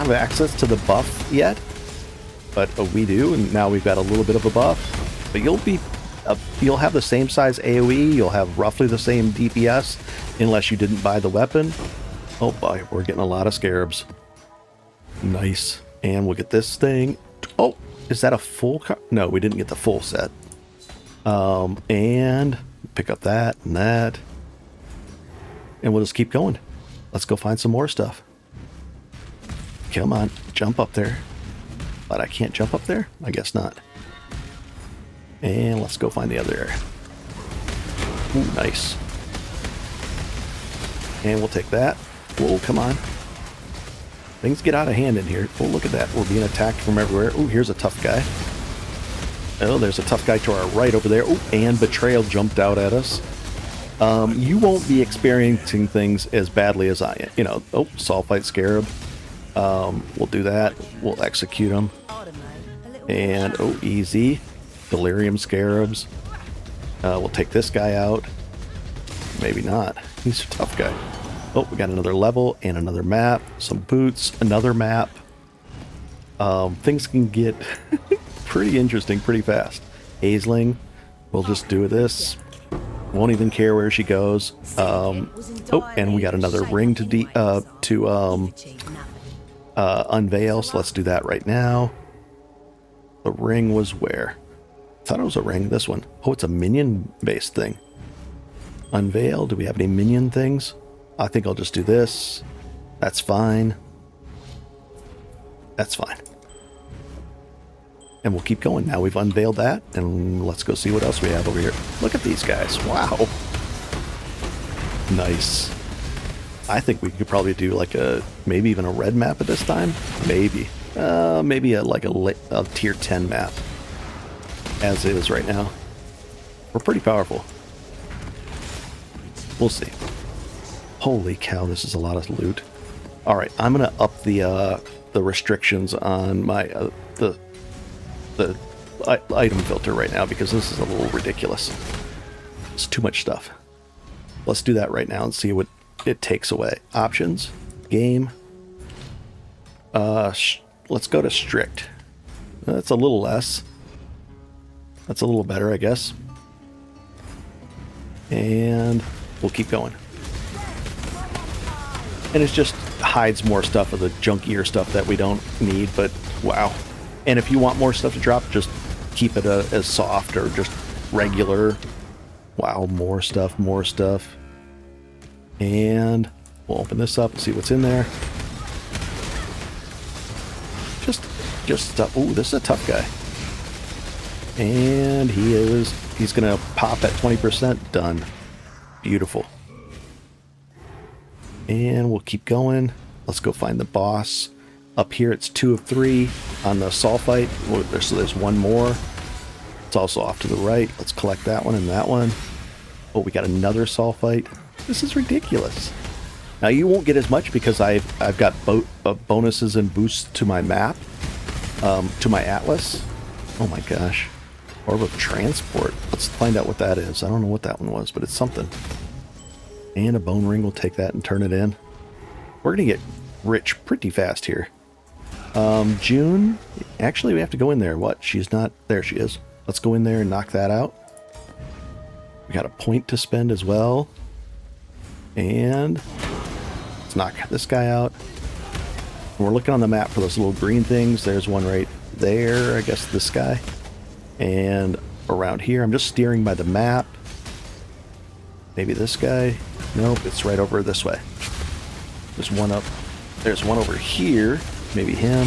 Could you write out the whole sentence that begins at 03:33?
Oh my gosh, orb of transport.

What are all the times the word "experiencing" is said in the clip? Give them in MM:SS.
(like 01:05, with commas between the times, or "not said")
00:55.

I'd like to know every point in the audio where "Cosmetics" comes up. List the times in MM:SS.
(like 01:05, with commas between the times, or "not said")
not said.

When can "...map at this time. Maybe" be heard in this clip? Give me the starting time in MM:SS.
01:59.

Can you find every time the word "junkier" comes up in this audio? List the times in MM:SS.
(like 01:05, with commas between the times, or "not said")
02:44.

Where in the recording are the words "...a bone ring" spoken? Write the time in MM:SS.
03:40.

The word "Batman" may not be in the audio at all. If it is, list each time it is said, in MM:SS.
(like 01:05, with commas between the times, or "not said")
not said.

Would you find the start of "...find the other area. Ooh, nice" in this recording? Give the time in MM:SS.
00:36.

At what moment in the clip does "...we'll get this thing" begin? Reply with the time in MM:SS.
00:16.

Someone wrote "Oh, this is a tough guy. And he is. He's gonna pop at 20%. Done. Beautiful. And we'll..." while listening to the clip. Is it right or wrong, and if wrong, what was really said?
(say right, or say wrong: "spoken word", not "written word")
right.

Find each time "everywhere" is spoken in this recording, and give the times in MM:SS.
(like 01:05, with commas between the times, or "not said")
00:46.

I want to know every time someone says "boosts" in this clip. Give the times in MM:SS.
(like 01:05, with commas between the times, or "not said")
03:29.